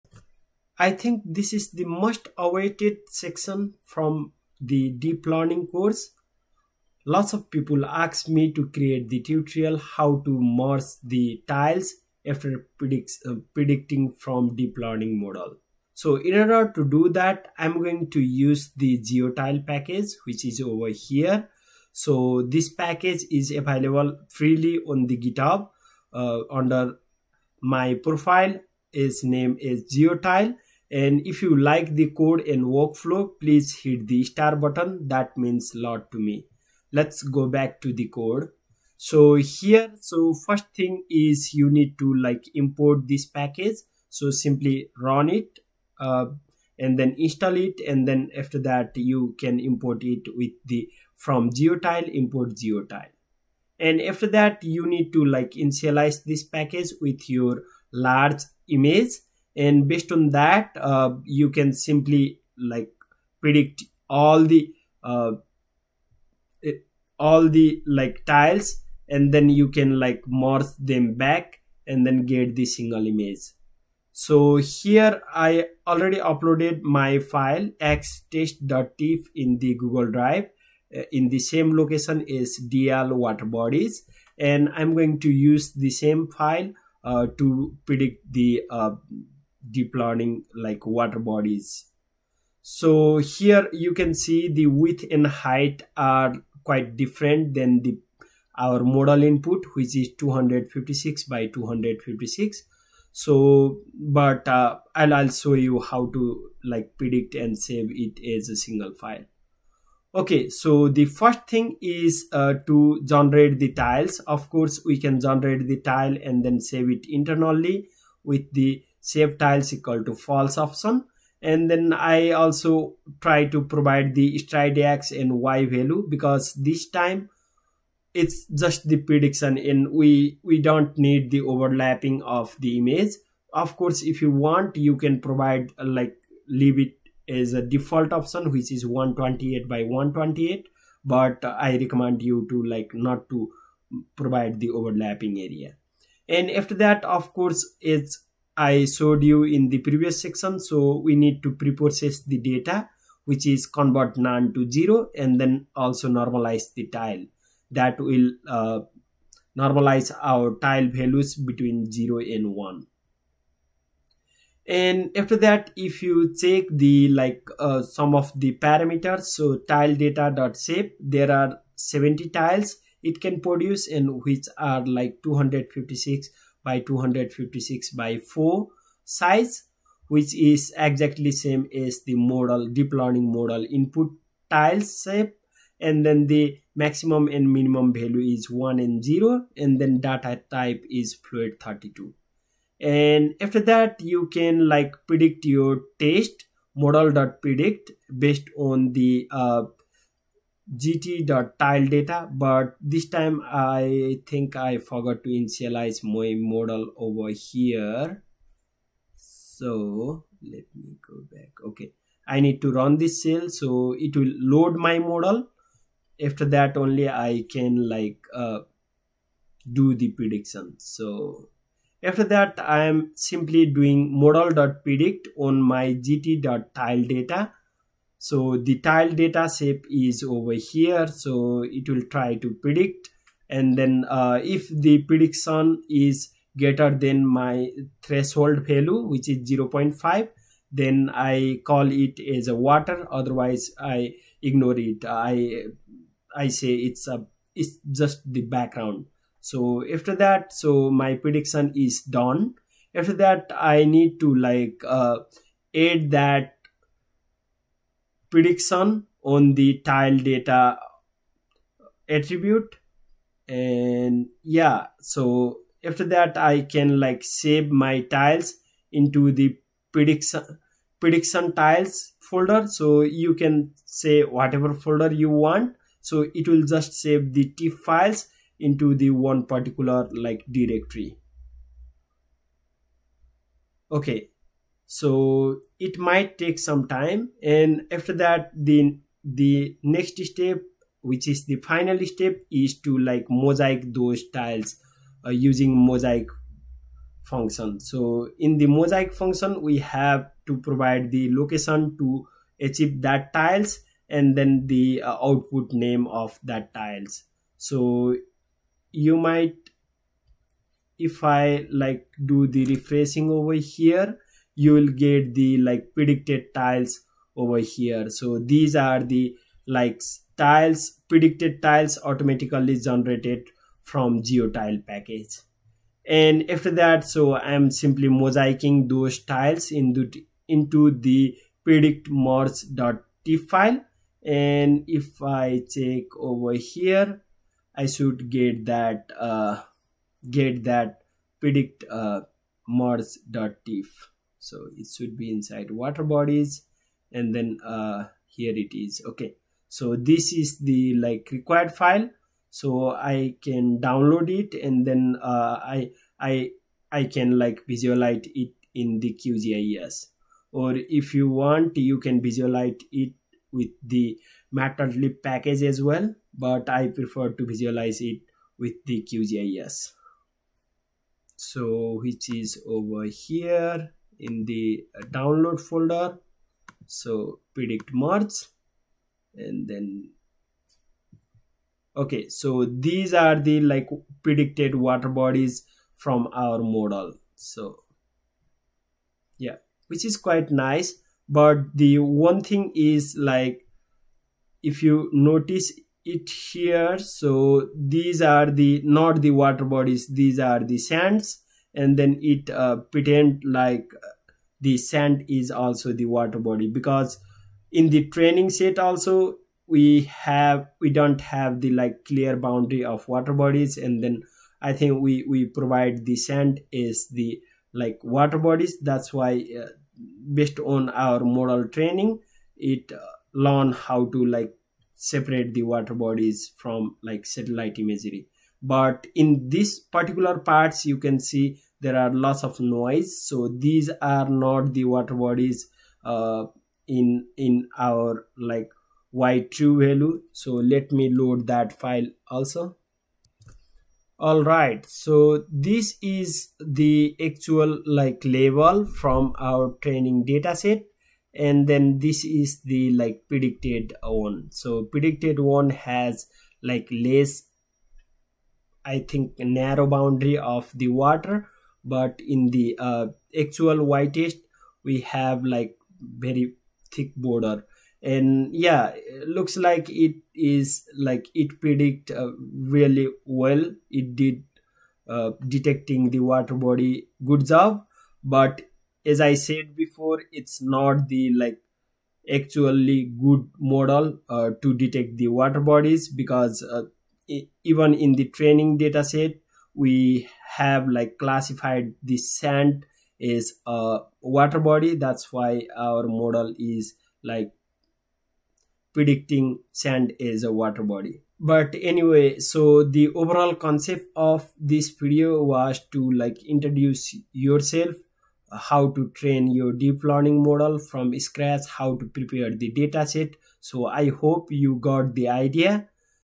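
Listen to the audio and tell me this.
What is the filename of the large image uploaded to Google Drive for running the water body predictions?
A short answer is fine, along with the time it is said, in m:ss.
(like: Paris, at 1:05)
xtest.tif, at 1:17.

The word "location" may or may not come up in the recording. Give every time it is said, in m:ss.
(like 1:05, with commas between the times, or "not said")
1:21, 5:01.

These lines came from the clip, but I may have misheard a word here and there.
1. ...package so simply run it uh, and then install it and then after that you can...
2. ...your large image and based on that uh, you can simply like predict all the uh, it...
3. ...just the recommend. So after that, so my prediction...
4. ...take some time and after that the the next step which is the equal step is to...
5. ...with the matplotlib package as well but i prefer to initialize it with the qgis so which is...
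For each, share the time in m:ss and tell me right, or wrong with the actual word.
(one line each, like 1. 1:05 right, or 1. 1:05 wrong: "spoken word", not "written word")
1. 0:43 right
2. 0:57 right
3. 4:07 wrong: "background", not "recommend"
4. 4:46 wrong: "final", not "equal"
5. 6:03 wrong: "visualize", not "initialize".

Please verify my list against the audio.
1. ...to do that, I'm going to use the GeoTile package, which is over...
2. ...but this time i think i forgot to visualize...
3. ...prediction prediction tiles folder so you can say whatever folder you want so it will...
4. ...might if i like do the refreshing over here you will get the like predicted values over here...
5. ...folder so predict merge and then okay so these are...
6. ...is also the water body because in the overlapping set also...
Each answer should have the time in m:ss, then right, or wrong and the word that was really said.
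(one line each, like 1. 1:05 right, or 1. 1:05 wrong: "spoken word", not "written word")
1. 0:16 right
2. 3:22 wrong: "initialize", not "visualize"
3. 4:29 right
4. 5:09 wrong: "tiles", not "values"
5. 6:15 right
6. 6:45 wrong: "training", not "overlapping".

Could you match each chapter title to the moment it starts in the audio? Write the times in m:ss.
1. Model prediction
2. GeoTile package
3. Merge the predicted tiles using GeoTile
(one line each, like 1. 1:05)
1. 3:12
2. 0:15
3. 4:14.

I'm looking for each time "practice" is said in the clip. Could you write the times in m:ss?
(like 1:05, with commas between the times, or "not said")
not said.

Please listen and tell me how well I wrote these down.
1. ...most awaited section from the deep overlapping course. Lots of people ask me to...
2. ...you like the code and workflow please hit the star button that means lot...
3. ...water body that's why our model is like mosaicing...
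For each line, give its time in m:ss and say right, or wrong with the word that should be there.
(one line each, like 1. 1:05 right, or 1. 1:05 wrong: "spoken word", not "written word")
1. 0:01 wrong: "learning", not "overlapping"
2. 0:31 right
3. 8:14 wrong: "predicting", not "mosaicing".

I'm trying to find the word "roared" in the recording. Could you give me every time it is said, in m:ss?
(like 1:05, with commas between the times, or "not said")
not said.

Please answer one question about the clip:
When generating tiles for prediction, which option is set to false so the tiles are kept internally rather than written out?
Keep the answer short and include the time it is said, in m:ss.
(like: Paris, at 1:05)
Save tiles, at 1:59.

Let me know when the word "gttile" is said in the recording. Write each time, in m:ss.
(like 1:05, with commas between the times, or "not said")
3:20, 3:45.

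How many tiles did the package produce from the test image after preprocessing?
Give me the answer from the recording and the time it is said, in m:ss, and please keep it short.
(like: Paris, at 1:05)
70, at 2:51.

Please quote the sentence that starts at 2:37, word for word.
That will uh, normalize our tile values between zero and one.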